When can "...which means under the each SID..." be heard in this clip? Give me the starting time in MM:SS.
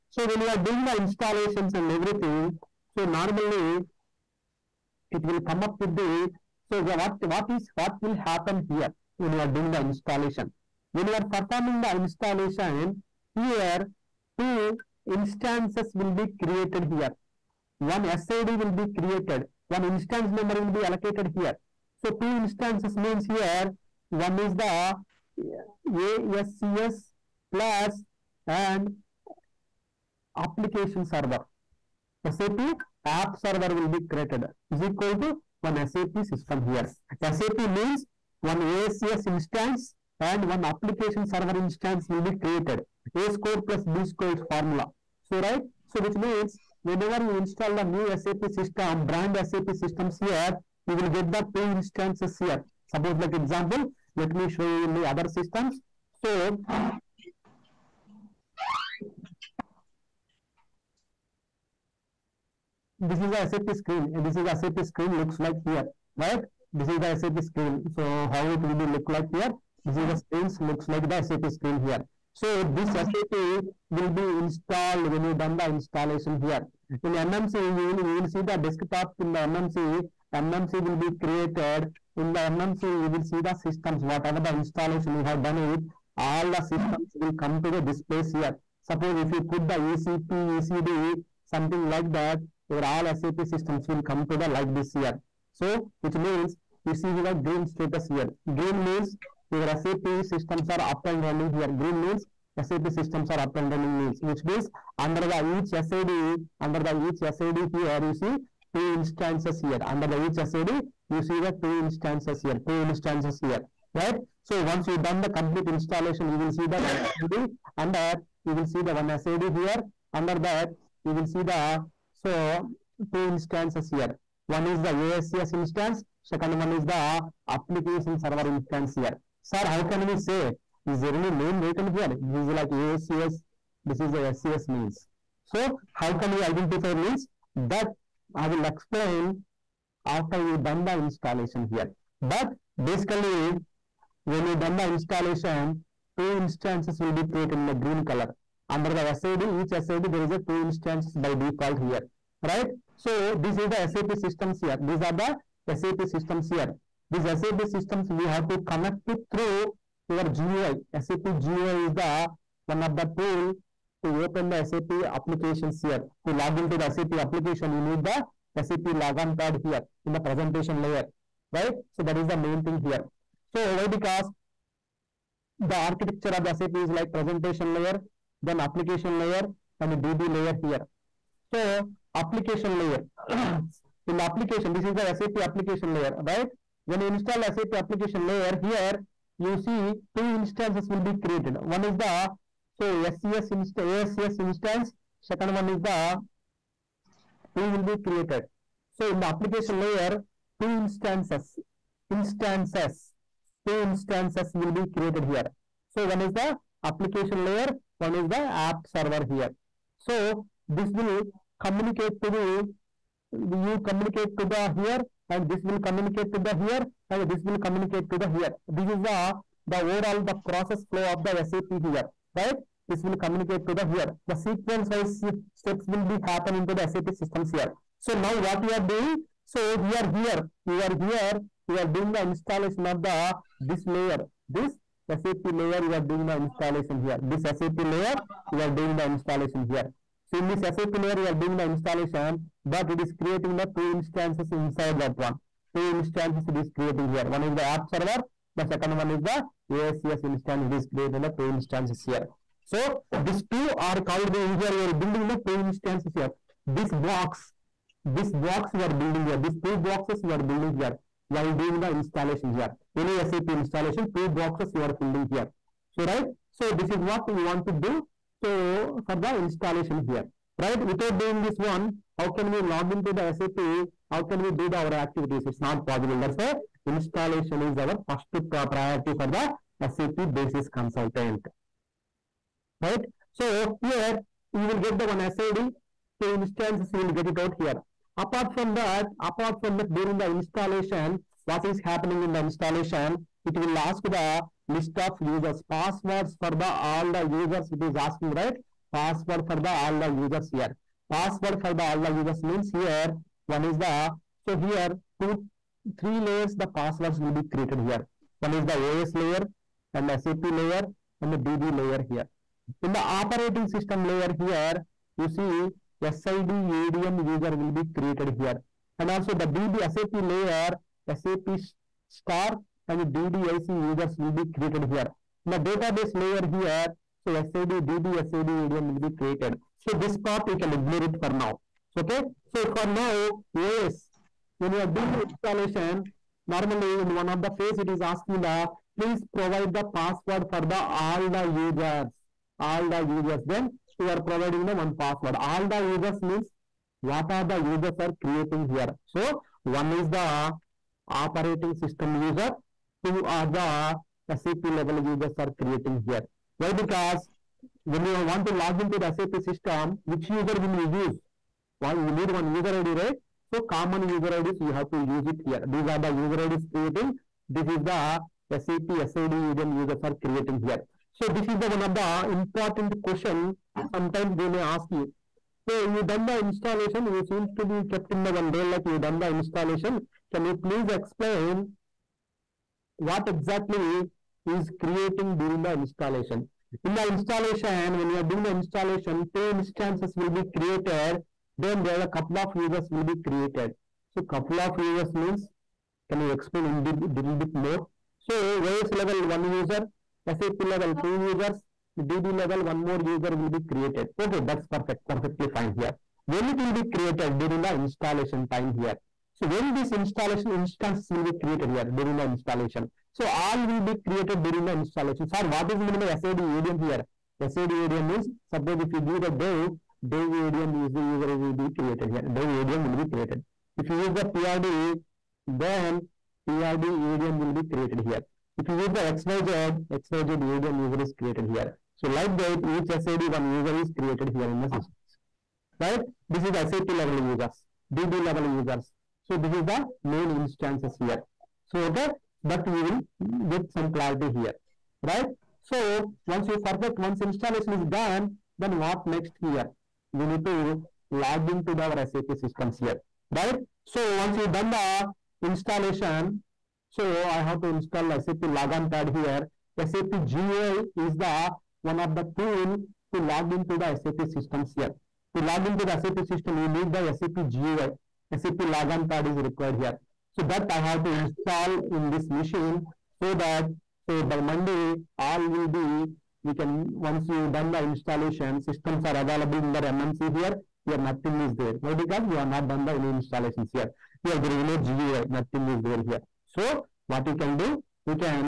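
01:44.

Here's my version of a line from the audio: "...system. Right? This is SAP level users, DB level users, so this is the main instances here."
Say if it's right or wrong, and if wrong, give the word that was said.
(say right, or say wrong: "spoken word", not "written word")
right.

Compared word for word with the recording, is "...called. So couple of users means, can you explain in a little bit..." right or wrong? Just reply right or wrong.
wrong.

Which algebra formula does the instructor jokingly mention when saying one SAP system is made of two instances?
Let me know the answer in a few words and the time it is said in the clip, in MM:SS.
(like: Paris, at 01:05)
A square plus B squared, at 00:43.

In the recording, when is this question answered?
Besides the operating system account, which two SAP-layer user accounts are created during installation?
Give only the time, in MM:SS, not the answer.
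05:21.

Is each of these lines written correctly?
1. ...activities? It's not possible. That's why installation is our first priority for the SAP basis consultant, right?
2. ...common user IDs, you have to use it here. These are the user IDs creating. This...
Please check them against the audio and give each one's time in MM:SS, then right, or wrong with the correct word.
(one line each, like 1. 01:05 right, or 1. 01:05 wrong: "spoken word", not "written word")
1. 04:34 right
2. 06:03 right.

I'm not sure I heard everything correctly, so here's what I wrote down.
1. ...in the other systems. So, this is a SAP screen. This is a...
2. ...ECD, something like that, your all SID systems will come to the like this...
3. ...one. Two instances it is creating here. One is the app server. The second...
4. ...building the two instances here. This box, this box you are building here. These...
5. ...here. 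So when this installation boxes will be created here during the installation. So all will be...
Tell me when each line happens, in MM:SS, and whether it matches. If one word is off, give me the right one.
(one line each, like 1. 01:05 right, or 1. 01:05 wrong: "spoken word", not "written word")
1. 00:54 right
2. 01:30 wrong: "SAP", not "SID"
3. 04:05 right
4. 04:14 right
5. 06:48 wrong: "instances", not "boxes".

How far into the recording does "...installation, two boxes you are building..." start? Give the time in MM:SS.
04:23.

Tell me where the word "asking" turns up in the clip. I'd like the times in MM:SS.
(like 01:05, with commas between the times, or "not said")
04:57, 05:38.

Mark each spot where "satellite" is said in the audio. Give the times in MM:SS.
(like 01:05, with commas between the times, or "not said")
not said.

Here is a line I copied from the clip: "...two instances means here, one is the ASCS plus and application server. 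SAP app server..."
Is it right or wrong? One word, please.
right.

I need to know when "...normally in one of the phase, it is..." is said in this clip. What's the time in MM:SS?
05:36.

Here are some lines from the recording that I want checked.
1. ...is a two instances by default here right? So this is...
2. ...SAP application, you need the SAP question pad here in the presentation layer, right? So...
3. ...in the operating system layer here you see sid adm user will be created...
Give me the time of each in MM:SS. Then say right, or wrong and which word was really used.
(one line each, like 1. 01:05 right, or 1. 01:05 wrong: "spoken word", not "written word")
1. 02:30 right
2. 02:46 wrong: "logon", not "question"
3. 05:12 right.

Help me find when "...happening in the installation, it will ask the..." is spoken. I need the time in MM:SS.
04:51.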